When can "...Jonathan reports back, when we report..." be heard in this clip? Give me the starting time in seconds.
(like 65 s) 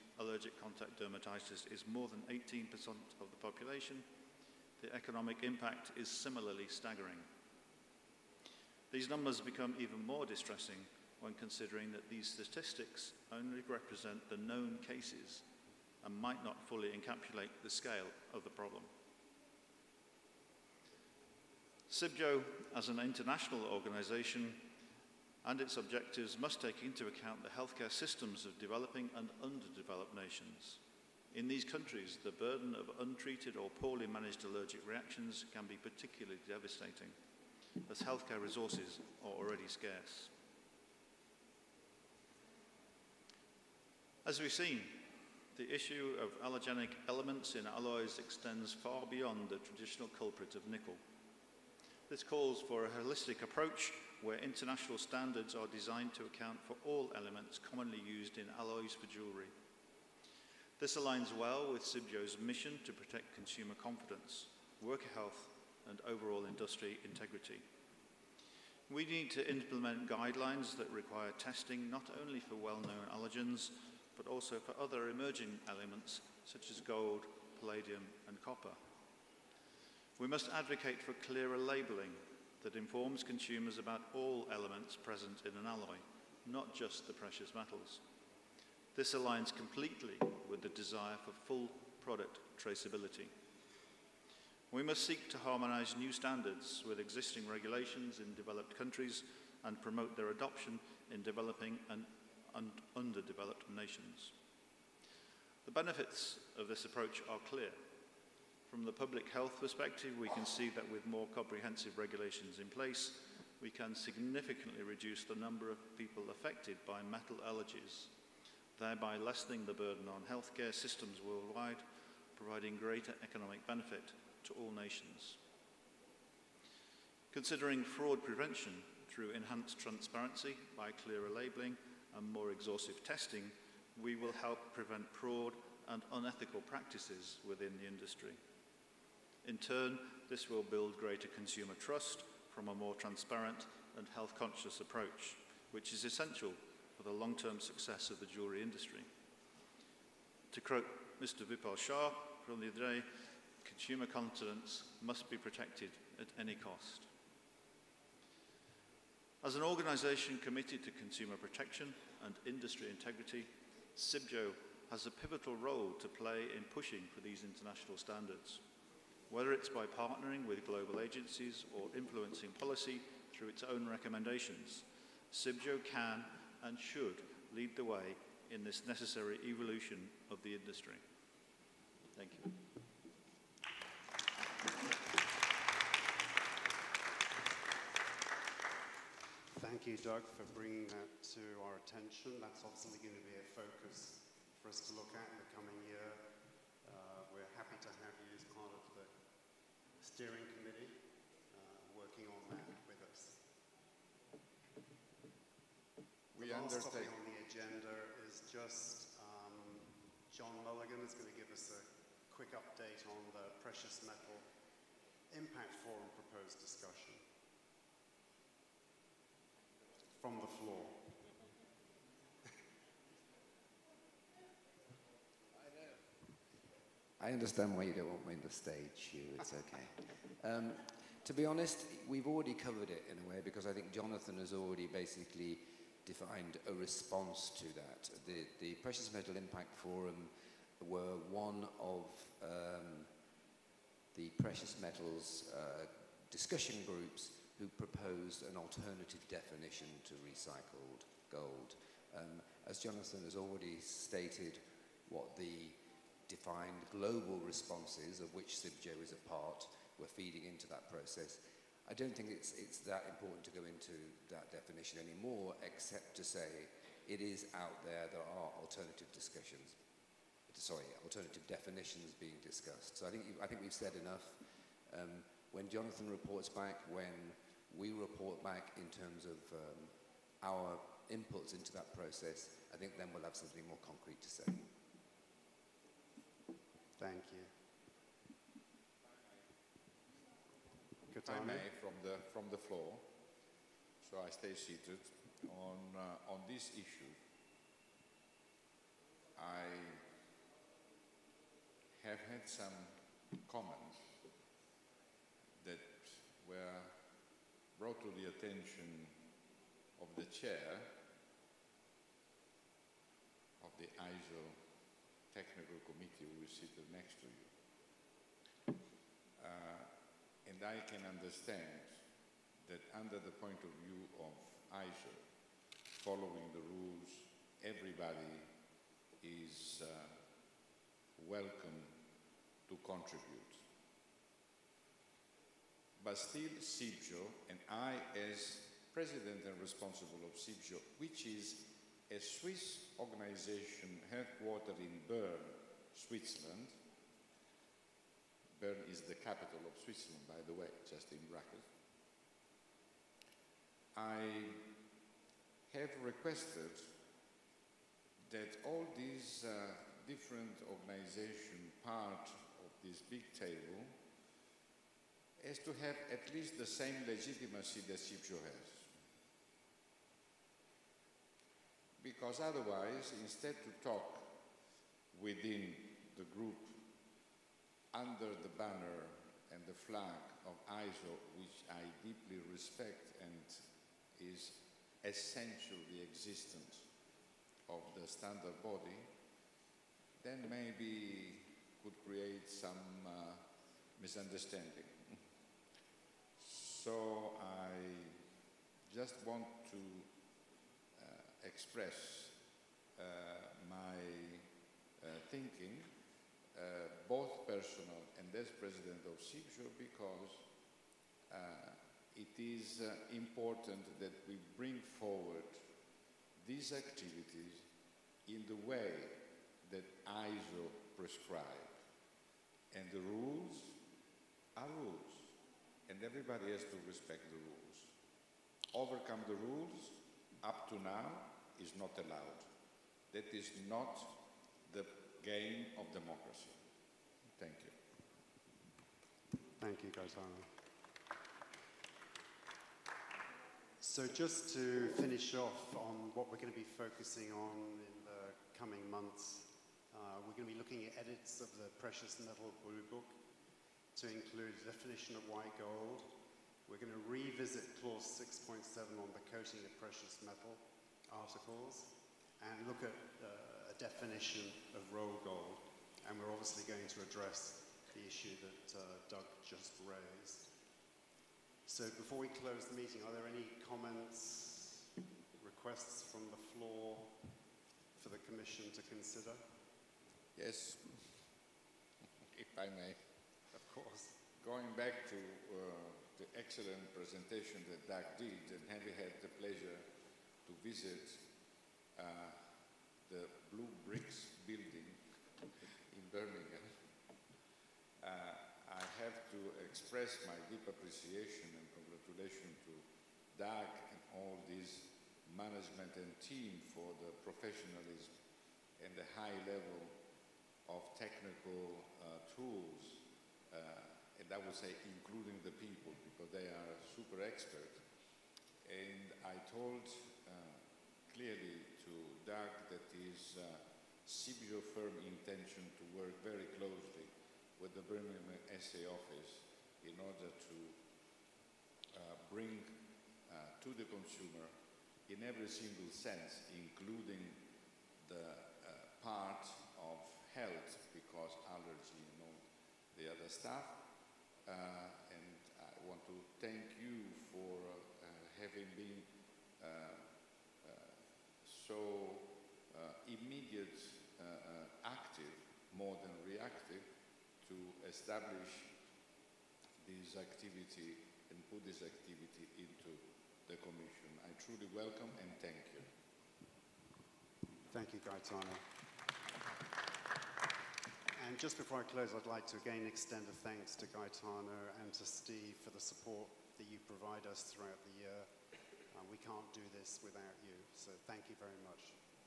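275 s.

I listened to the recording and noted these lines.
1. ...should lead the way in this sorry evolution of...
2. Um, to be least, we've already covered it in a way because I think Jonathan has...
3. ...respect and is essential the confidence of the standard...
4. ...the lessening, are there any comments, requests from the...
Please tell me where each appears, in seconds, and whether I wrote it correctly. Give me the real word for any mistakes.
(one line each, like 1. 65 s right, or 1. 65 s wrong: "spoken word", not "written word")
1. 176 s wrong: "necessary", not "sorry"
2. 230 s wrong: "honest", not "least"
3. 382 s wrong: "existence", not "confidence"
4. 472 s wrong: "meeting", not "lessening".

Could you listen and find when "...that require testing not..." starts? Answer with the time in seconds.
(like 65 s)
70 s.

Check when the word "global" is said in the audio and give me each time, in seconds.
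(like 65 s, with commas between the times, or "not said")
170 s, 256 s.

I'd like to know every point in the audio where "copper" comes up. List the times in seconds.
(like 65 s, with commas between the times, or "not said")
78 s.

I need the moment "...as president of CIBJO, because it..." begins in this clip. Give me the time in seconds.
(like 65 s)
408 s.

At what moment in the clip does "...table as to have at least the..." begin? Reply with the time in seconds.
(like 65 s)
363 s.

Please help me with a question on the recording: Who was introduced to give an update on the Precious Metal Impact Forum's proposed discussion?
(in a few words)
John Mulligan.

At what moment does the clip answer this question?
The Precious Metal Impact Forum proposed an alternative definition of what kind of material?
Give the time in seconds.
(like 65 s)
250 s.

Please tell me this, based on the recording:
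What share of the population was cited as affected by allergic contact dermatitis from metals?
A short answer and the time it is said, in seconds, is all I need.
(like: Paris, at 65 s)
More than 18%, at 1 s.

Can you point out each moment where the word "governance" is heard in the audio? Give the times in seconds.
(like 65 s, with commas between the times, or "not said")
not said.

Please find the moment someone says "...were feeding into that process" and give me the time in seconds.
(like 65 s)
259 s.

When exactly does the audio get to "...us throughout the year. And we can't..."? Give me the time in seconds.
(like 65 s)
577 s.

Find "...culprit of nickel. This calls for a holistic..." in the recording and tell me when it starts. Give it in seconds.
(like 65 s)
50 s.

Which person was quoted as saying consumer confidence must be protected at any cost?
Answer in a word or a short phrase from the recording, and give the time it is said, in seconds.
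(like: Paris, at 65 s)
Vipul Shah, at 151 s.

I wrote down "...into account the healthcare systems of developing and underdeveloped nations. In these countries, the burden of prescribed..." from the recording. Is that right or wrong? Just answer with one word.
wrong.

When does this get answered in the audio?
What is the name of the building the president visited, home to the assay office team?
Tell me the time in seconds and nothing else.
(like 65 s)
493 s.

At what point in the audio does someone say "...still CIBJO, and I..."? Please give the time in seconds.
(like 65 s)
336 s.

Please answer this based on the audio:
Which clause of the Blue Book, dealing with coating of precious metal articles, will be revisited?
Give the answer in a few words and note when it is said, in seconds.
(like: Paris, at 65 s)
6.7, at 457 s.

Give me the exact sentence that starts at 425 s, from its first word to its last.
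And everybody has to respect the rules.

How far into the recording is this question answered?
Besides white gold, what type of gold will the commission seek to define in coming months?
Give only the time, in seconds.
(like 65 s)
464 s.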